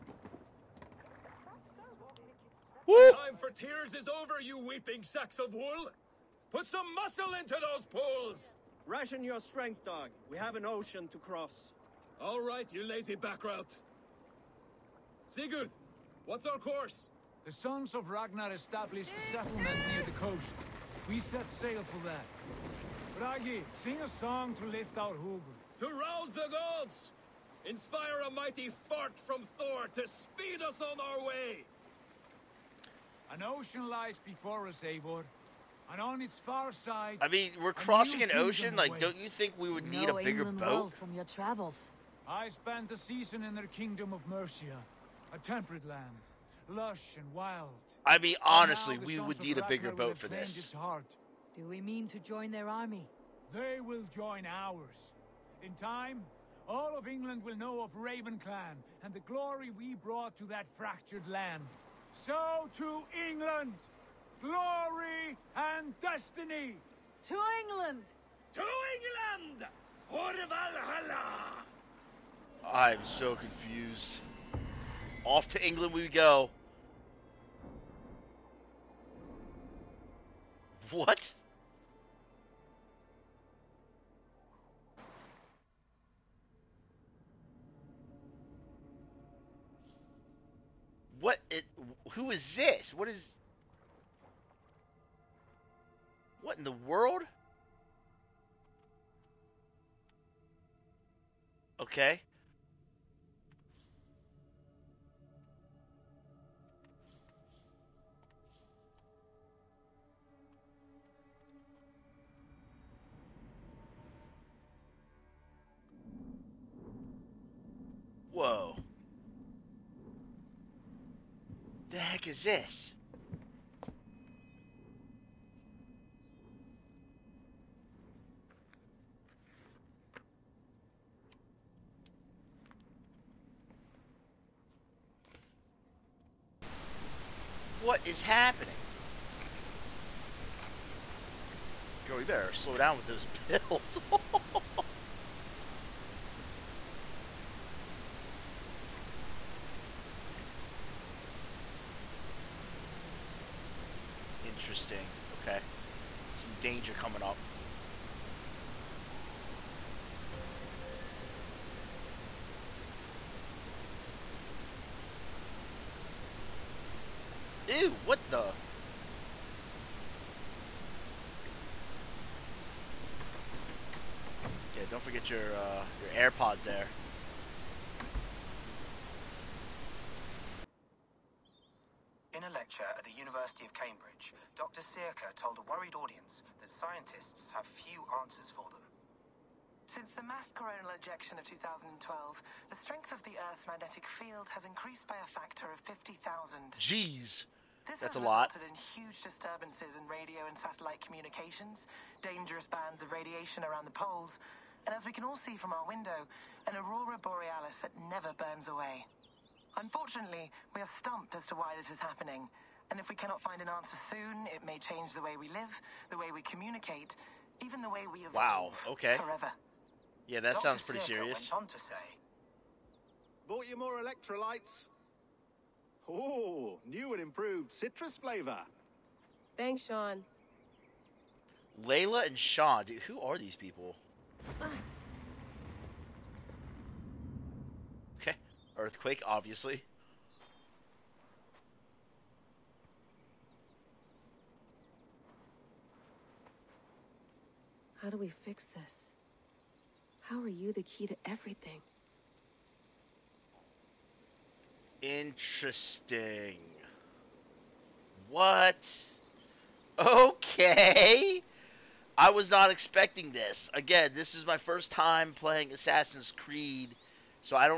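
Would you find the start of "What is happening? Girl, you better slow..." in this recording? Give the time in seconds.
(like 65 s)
137 s.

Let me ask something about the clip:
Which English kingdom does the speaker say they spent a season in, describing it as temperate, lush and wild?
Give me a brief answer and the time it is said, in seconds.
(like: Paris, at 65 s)
Mercia, at 44 s.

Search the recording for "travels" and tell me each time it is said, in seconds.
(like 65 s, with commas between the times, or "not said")
41 s.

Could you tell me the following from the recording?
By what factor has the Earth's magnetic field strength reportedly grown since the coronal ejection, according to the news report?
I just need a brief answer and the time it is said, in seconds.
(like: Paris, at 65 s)
50,000, at 195 s.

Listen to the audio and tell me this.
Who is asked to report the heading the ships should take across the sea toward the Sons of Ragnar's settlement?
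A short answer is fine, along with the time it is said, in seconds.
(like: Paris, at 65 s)
Sigurd, at 15 s.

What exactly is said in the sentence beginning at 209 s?
Unfortunately, we are stumped as to why this is happening.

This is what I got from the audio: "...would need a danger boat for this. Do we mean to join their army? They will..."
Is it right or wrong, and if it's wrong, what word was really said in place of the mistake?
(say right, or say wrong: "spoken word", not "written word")
wrong: "bigger", not "danger".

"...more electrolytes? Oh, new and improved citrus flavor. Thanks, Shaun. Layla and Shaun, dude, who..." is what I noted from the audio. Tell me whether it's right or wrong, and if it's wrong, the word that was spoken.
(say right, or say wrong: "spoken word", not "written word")
right.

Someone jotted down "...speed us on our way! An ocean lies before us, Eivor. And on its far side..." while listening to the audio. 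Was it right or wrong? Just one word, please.
right.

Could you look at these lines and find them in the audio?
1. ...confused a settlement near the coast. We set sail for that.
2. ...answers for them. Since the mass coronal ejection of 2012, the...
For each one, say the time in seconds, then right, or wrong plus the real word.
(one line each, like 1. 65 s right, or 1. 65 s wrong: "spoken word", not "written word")
1. 18 s wrong: "established", not "confused"
2. 188 s right.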